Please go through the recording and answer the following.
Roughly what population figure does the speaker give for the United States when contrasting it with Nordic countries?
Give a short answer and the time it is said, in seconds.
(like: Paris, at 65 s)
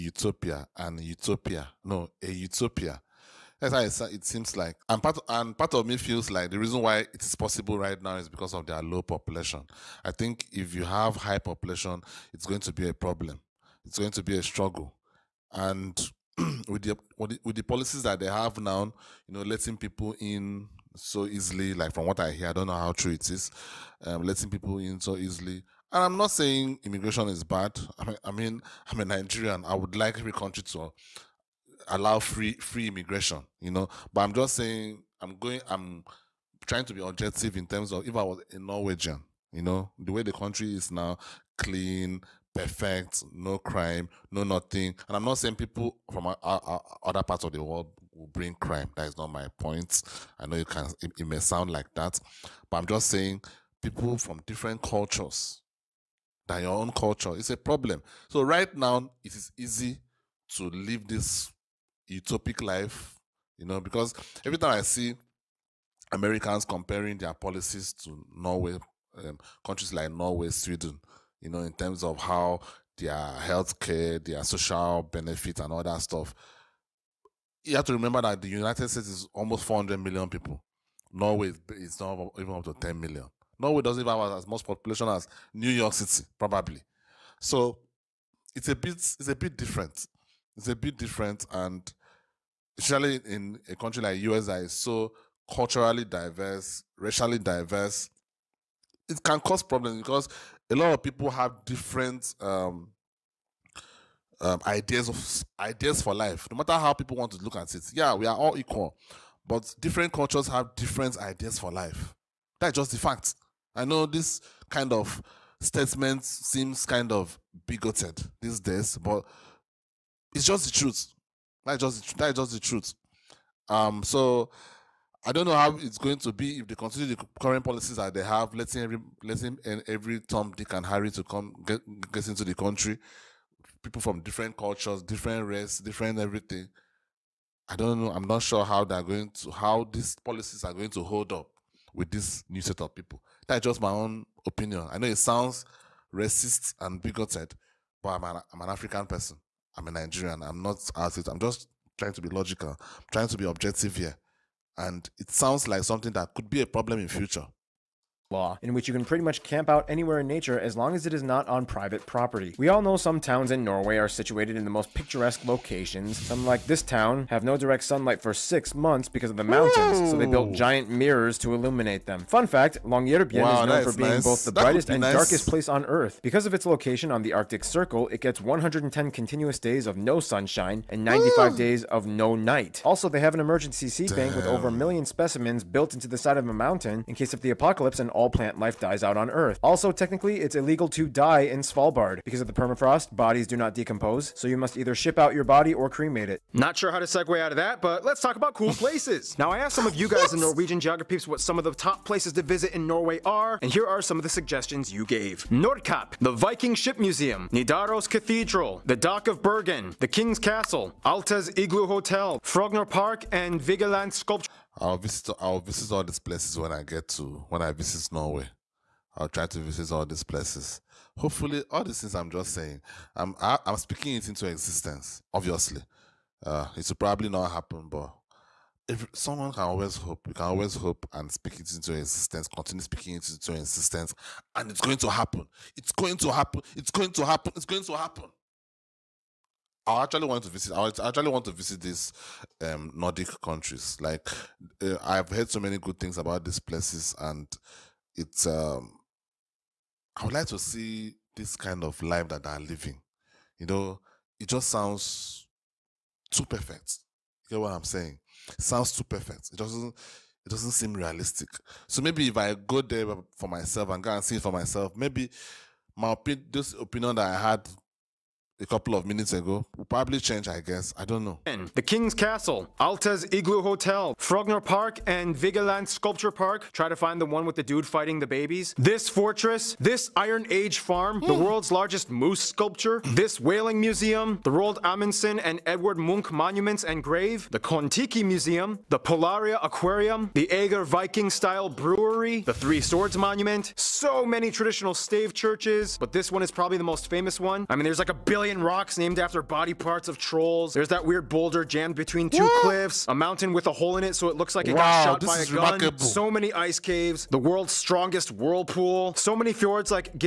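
almost 400 million, at 79 s.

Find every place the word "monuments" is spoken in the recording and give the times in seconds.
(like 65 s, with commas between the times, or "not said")
286 s, 293 s.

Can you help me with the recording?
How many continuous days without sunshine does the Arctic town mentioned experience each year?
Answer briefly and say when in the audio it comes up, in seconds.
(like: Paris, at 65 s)
110, at 178 s.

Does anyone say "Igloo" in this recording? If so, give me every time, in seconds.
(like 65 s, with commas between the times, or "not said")
211 s, 273 s.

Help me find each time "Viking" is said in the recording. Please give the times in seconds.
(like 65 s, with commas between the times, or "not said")
206 s, 290 s.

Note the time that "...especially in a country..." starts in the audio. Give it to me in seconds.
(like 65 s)
92 s.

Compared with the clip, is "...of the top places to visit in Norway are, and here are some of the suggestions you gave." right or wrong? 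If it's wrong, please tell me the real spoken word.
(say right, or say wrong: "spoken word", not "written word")
right.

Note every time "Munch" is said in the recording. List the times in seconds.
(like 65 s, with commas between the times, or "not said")
285 s.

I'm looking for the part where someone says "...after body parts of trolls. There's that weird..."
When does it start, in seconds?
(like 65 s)
299 s.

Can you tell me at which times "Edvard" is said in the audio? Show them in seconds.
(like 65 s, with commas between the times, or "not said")
285 s.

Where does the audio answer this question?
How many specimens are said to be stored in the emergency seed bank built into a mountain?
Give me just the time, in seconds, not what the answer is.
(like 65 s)
184 s.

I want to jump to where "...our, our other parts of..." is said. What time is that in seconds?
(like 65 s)
46 s.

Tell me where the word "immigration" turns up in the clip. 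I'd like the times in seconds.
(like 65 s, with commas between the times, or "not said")
26 s, 32 s.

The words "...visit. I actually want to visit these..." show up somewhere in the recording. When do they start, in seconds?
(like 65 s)
240 s.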